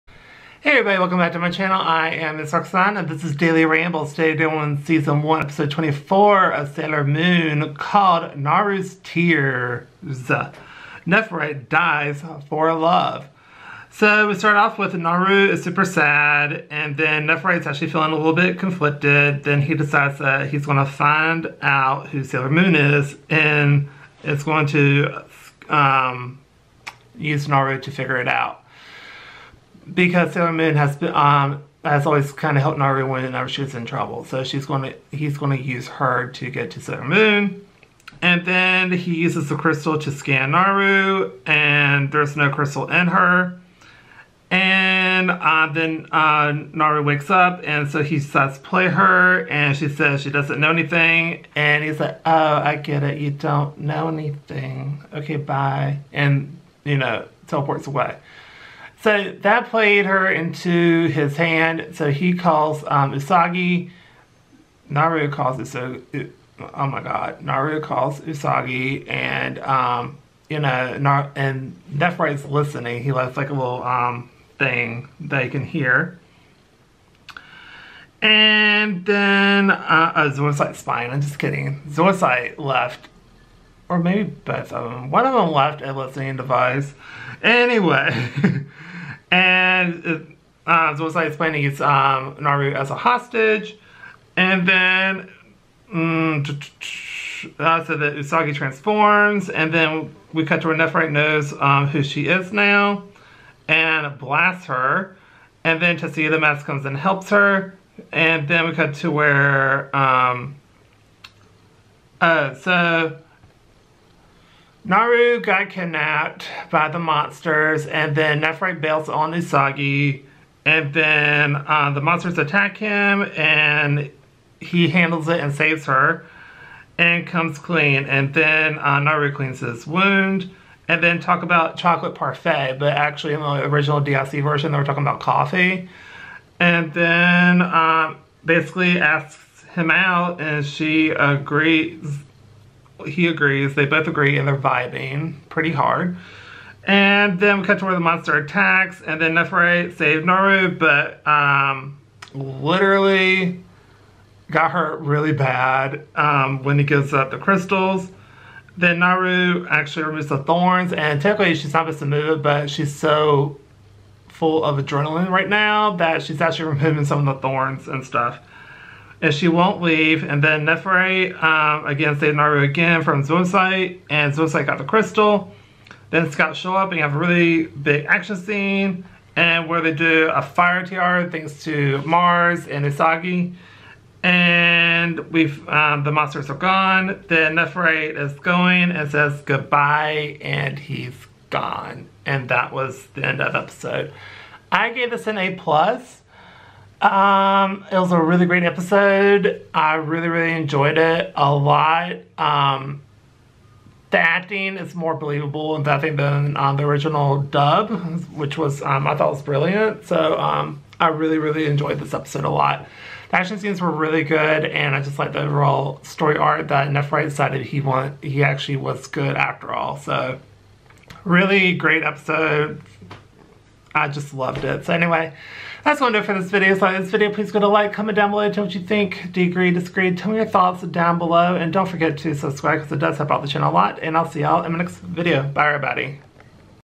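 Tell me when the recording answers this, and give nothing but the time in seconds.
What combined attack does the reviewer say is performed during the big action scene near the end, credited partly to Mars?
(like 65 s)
180 s.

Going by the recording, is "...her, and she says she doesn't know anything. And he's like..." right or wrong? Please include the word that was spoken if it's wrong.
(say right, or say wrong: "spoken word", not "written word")
right.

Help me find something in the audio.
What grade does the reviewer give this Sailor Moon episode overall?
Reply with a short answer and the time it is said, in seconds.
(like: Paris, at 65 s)
A plus, at 195 s.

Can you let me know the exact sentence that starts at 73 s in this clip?
He left like a little um, thing that he can hear.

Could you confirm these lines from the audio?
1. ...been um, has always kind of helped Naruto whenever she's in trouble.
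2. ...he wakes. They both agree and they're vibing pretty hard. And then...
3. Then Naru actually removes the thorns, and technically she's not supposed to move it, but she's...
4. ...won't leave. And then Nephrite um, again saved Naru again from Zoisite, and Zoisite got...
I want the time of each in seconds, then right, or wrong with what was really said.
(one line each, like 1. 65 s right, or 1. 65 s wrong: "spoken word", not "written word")
1. 30 s right
2. 143 s wrong: "agrees", not "wakes"
3. 158 s right
4. 169 s right.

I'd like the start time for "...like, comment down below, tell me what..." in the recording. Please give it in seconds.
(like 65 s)
227 s.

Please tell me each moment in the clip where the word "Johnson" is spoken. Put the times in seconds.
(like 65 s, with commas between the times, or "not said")
not said.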